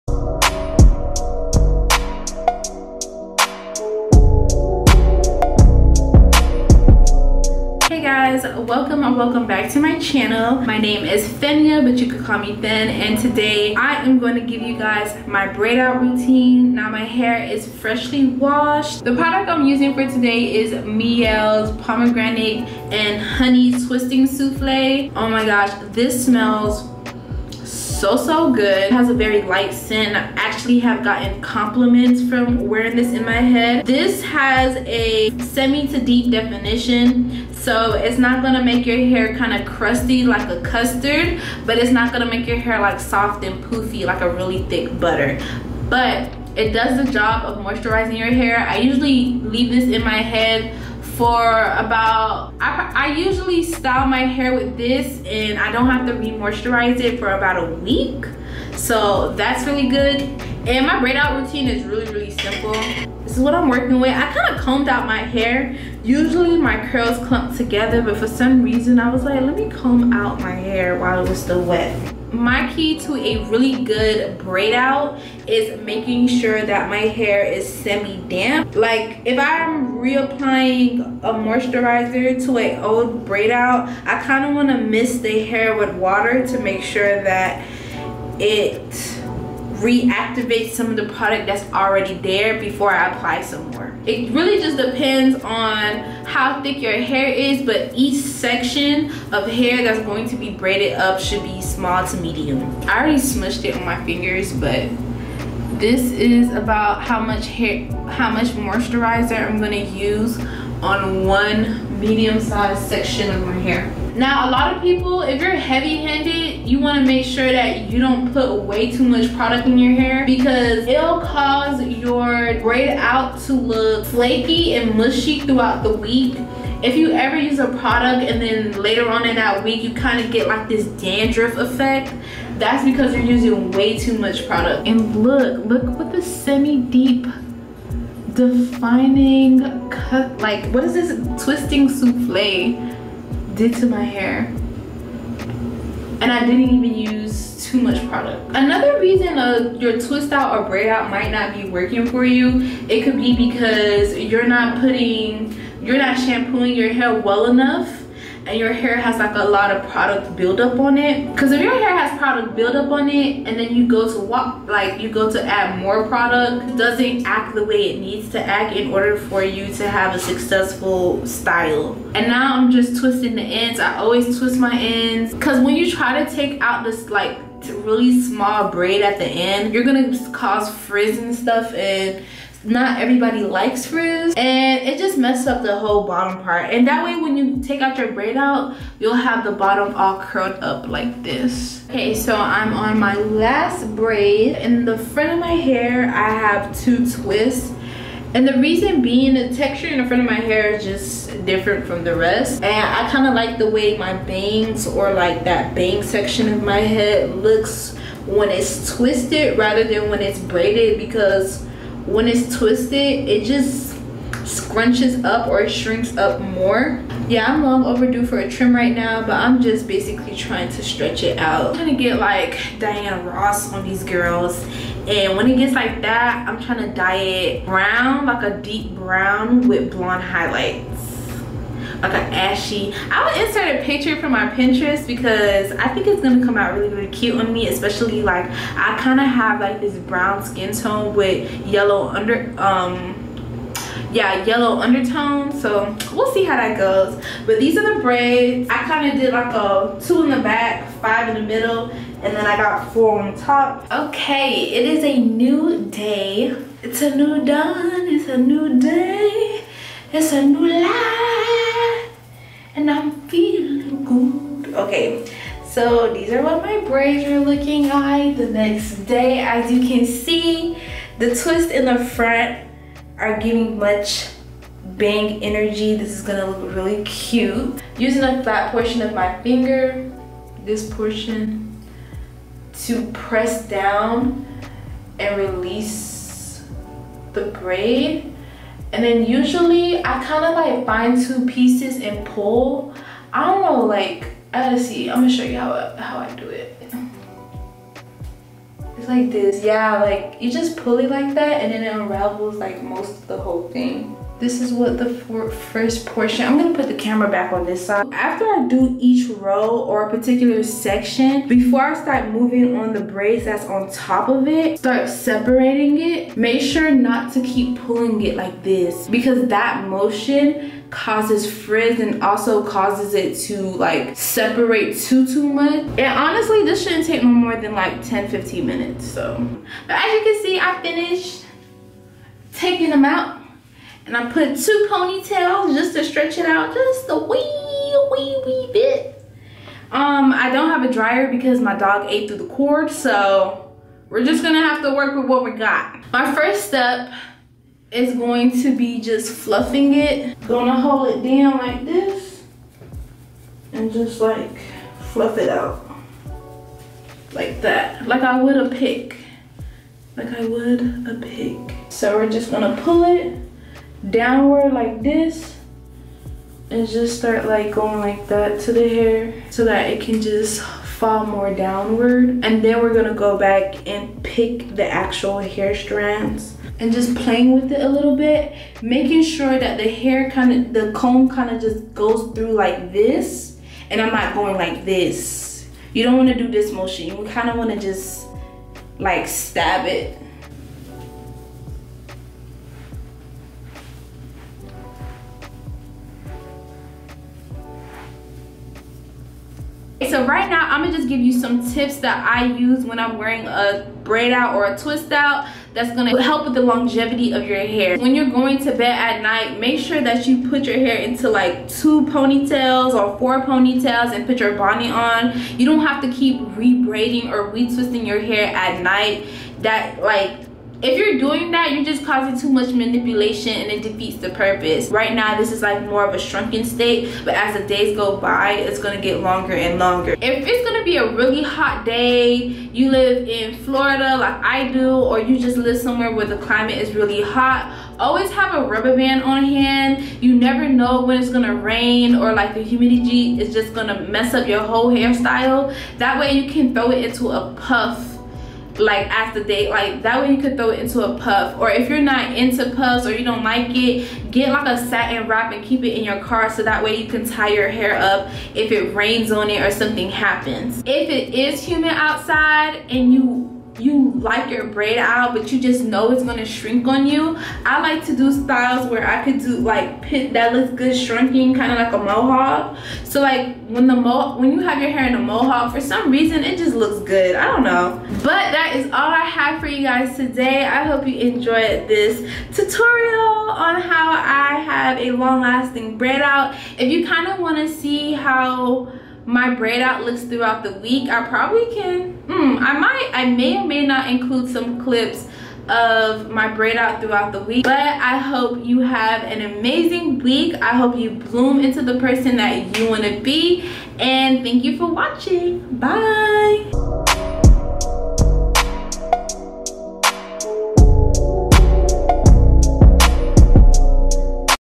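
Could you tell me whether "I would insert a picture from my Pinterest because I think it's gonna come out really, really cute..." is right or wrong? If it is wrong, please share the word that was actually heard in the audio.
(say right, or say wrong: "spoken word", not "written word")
right.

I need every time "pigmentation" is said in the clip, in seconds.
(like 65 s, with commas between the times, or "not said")
not said.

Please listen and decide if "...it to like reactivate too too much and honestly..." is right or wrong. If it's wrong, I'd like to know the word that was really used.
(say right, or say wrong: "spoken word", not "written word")
wrong: "separate", not "reactivate".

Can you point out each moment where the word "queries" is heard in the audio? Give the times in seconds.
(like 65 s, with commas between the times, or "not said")
not said.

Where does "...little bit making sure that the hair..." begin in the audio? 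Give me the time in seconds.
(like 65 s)
377 s.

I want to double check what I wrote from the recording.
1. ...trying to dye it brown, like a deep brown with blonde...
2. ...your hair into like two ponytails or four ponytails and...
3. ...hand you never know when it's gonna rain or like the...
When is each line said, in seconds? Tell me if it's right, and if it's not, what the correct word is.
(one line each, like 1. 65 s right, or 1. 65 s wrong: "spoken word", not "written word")
1. 226 s right
2. 410 s right
3. 439 s right.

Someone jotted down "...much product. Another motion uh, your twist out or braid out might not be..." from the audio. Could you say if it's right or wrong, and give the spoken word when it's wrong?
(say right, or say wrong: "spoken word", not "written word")
wrong: "reason", not "motion".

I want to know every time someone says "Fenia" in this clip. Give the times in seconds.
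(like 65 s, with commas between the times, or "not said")
11 s.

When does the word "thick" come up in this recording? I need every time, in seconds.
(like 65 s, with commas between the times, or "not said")
44 s, 96 s.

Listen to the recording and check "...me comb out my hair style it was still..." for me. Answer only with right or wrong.
wrong.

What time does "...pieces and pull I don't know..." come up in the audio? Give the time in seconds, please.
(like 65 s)
291 s.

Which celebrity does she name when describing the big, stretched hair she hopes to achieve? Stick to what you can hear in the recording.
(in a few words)
Diana Ross.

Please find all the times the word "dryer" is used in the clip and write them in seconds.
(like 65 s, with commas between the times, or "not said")
340 s.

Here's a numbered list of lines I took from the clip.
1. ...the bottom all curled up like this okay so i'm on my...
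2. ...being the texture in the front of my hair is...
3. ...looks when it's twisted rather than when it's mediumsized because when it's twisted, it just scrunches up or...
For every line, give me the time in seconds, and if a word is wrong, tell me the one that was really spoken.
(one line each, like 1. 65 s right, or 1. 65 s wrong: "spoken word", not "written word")
1. 189 s right
2. 199 s right
3. 207 s wrong: "braided", not "mediumsized".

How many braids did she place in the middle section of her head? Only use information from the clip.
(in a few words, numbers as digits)
5.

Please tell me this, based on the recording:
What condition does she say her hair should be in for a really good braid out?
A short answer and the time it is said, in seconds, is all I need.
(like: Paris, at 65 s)
semi-damp, at 77 s.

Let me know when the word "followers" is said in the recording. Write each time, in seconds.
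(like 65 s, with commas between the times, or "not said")
not said.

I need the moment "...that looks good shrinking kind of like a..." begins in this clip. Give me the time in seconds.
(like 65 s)
470 s.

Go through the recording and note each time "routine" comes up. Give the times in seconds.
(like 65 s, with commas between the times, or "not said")
15 s, 61 s.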